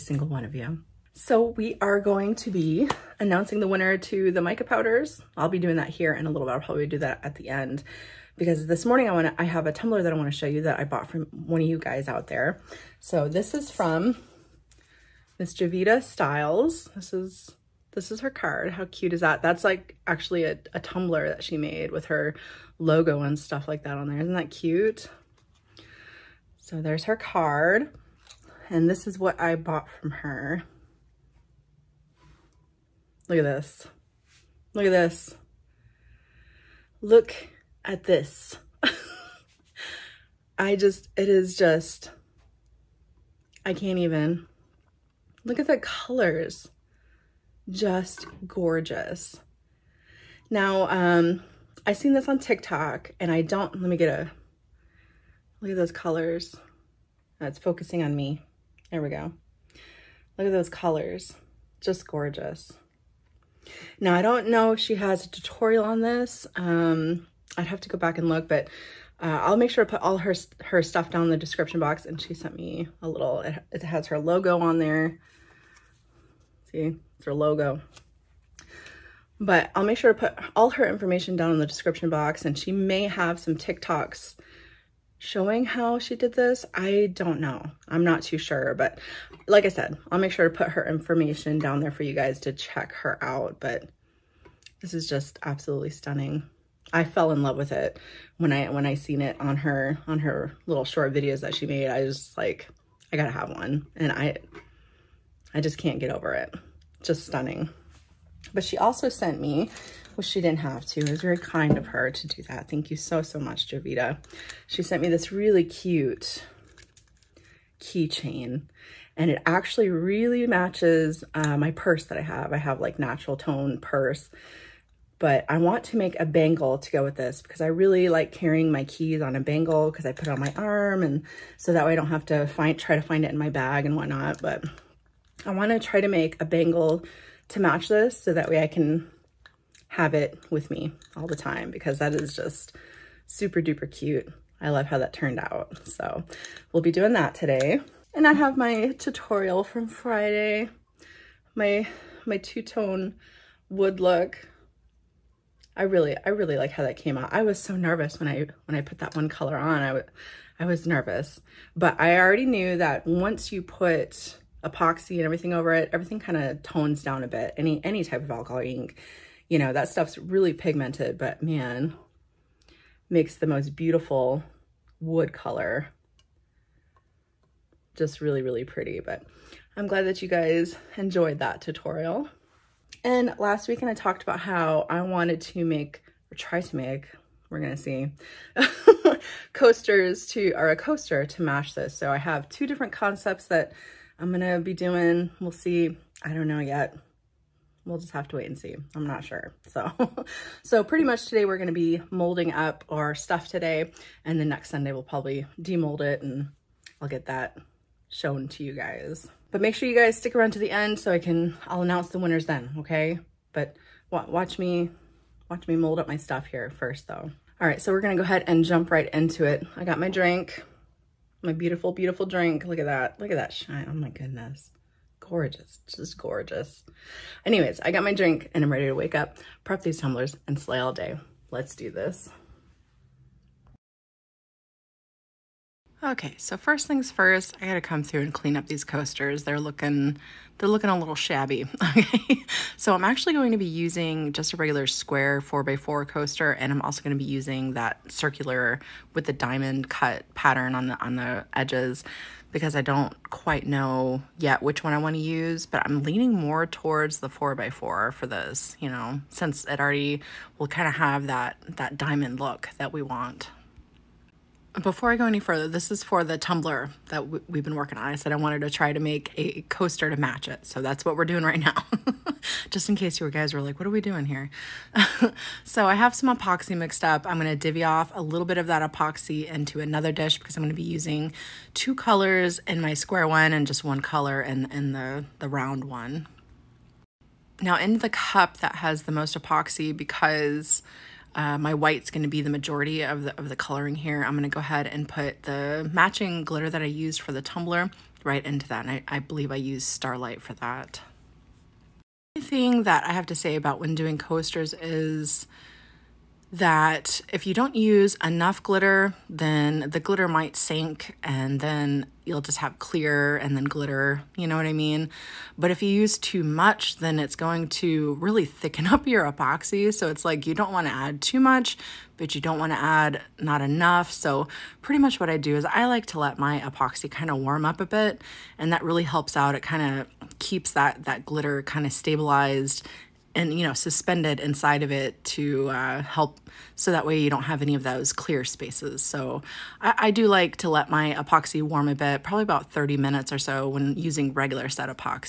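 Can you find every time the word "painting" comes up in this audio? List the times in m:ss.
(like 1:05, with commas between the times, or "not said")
not said.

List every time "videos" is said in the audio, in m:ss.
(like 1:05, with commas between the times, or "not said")
1:41.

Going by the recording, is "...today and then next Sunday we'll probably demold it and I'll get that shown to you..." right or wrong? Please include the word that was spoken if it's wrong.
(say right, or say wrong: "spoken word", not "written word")
right.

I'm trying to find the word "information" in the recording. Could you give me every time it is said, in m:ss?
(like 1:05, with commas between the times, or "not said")
1:20, 1:30.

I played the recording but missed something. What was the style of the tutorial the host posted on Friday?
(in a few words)
Two-tone wood look.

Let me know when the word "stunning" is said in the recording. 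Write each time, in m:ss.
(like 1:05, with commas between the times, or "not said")
1:35, 1:47.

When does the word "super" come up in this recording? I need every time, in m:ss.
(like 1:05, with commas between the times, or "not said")
2:23.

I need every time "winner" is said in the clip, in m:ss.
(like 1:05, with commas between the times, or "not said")
0:03, 3:32.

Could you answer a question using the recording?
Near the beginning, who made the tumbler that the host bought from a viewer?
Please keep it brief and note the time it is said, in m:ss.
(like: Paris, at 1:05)
Jovita Styles, at 0:15.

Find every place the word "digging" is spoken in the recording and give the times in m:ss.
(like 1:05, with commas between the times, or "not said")
not said.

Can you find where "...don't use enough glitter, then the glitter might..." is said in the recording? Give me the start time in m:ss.
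5:07.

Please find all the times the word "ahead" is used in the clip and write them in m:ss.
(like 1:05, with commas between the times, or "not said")
3:38, 4:54.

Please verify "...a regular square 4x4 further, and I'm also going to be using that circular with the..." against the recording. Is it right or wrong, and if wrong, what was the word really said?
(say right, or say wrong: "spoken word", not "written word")
wrong: "coaster", not "further".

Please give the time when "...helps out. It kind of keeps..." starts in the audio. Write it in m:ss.
5:29.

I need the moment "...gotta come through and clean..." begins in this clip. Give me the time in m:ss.
3:57.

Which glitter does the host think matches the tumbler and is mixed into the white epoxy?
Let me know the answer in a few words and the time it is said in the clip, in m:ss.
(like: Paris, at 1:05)
Starlight, at 4:59.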